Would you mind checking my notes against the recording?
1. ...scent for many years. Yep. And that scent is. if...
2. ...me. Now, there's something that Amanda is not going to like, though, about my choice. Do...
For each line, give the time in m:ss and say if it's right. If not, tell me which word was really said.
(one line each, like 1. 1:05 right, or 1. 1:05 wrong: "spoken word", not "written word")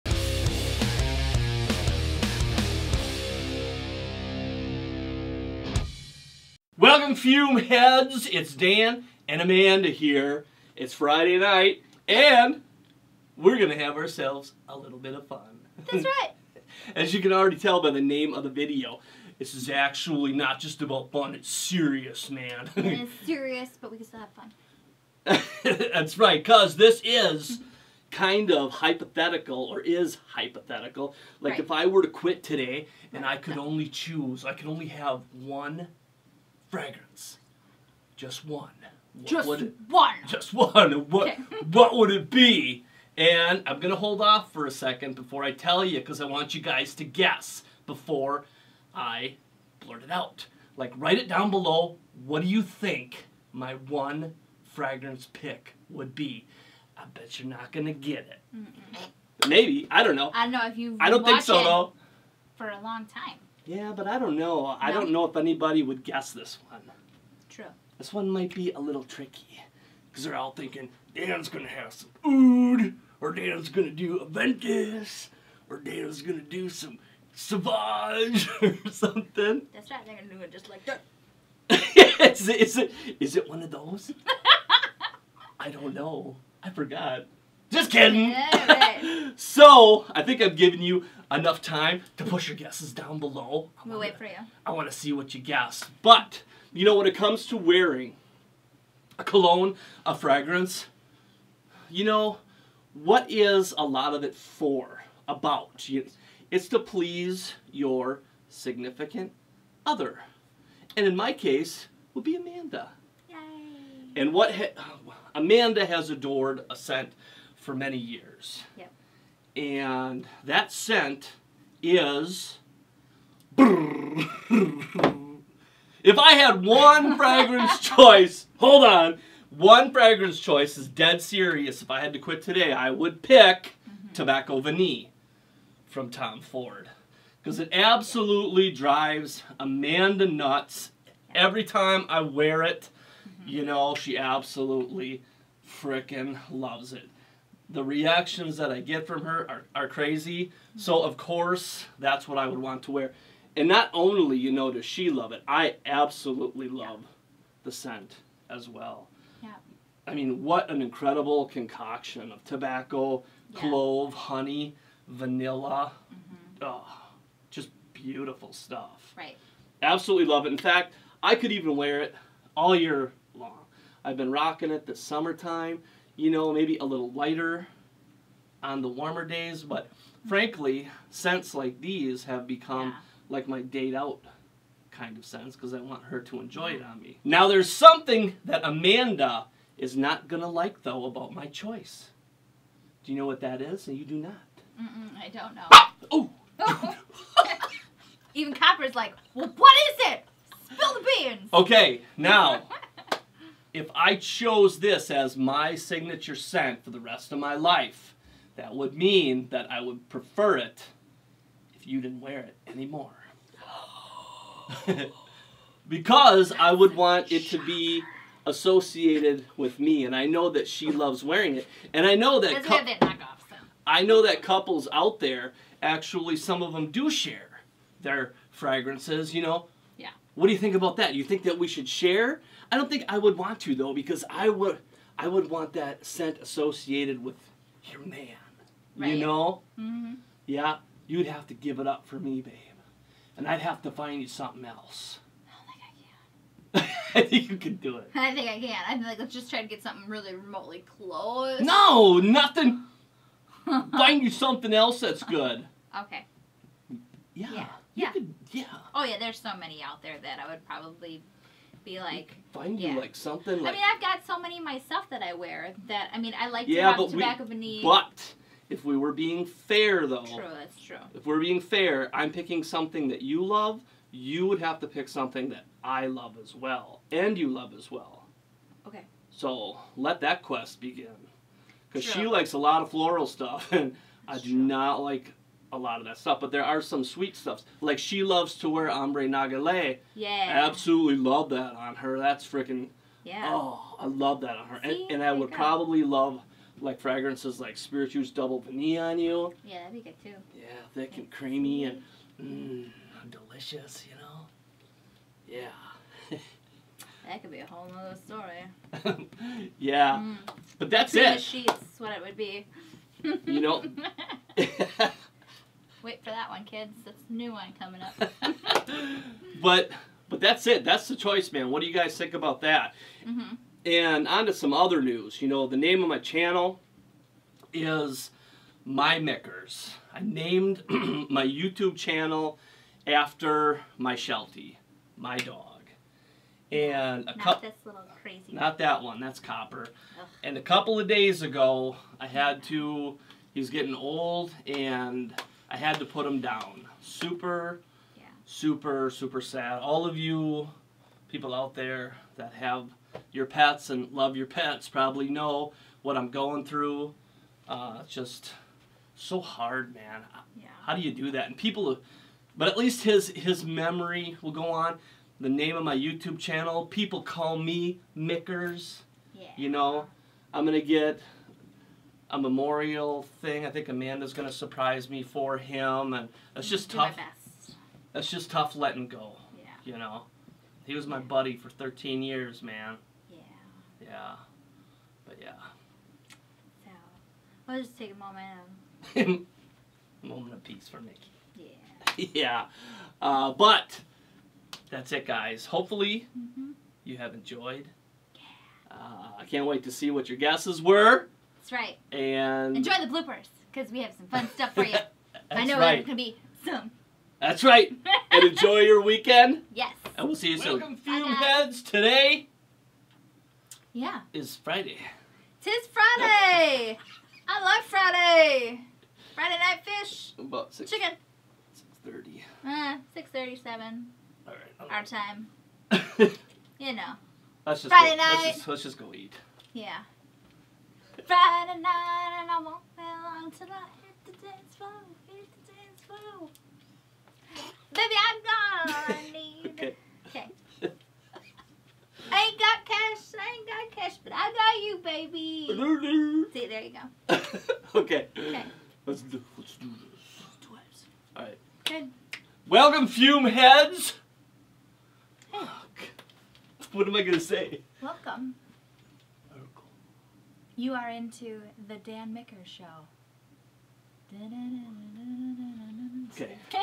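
1. 1:56 right
2. 3:07 right.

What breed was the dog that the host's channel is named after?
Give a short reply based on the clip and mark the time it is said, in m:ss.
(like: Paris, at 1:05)
Sheltie, at 5:34.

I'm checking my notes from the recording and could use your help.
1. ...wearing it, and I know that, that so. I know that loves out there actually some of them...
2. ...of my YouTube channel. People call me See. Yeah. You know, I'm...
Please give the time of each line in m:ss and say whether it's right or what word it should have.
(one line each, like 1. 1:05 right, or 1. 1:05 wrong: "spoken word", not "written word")
1. 3:41 wrong: "couples", not "loves"
2. 6:05 wrong: "Mickers", not "See".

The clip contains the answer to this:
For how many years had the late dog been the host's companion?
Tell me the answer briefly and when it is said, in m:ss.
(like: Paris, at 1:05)
13, at 6:21.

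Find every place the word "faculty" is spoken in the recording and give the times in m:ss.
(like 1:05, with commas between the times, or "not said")
not said.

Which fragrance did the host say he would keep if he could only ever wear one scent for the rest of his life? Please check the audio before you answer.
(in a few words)
Tobacco Vanille.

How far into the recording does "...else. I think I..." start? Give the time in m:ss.
4:04.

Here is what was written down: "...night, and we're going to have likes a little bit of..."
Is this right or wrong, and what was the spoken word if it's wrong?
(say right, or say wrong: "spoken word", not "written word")
wrong: "ourselves", not "likes".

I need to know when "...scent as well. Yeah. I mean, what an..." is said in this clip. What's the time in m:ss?
2:37.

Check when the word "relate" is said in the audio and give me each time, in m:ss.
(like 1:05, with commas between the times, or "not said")
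not said.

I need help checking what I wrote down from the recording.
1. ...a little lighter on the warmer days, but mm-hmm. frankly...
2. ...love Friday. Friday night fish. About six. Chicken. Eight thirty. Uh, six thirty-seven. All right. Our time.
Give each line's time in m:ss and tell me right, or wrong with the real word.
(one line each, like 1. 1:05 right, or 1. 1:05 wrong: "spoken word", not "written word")
1. 2:56 right
2. 6:57 wrong: "Six", not "Eight".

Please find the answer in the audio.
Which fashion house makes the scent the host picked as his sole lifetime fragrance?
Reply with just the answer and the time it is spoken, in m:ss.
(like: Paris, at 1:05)
Tom Ford, at 2:16.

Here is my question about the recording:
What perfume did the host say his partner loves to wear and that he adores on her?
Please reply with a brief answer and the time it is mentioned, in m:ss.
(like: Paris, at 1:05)
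Ombre Nagale, at 4:48.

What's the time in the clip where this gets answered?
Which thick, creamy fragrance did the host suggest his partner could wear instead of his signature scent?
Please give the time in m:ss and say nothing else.
4:57.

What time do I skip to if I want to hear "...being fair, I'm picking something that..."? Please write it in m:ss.
4:31.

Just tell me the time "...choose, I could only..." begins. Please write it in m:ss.
0:33.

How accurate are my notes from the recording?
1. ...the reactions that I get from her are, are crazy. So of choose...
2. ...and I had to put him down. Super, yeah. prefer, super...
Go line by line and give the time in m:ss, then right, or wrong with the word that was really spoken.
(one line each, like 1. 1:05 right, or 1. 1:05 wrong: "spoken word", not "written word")
1. 2:27 wrong: "course", not "choose"
2. 5:44 wrong: "super", not "prefer".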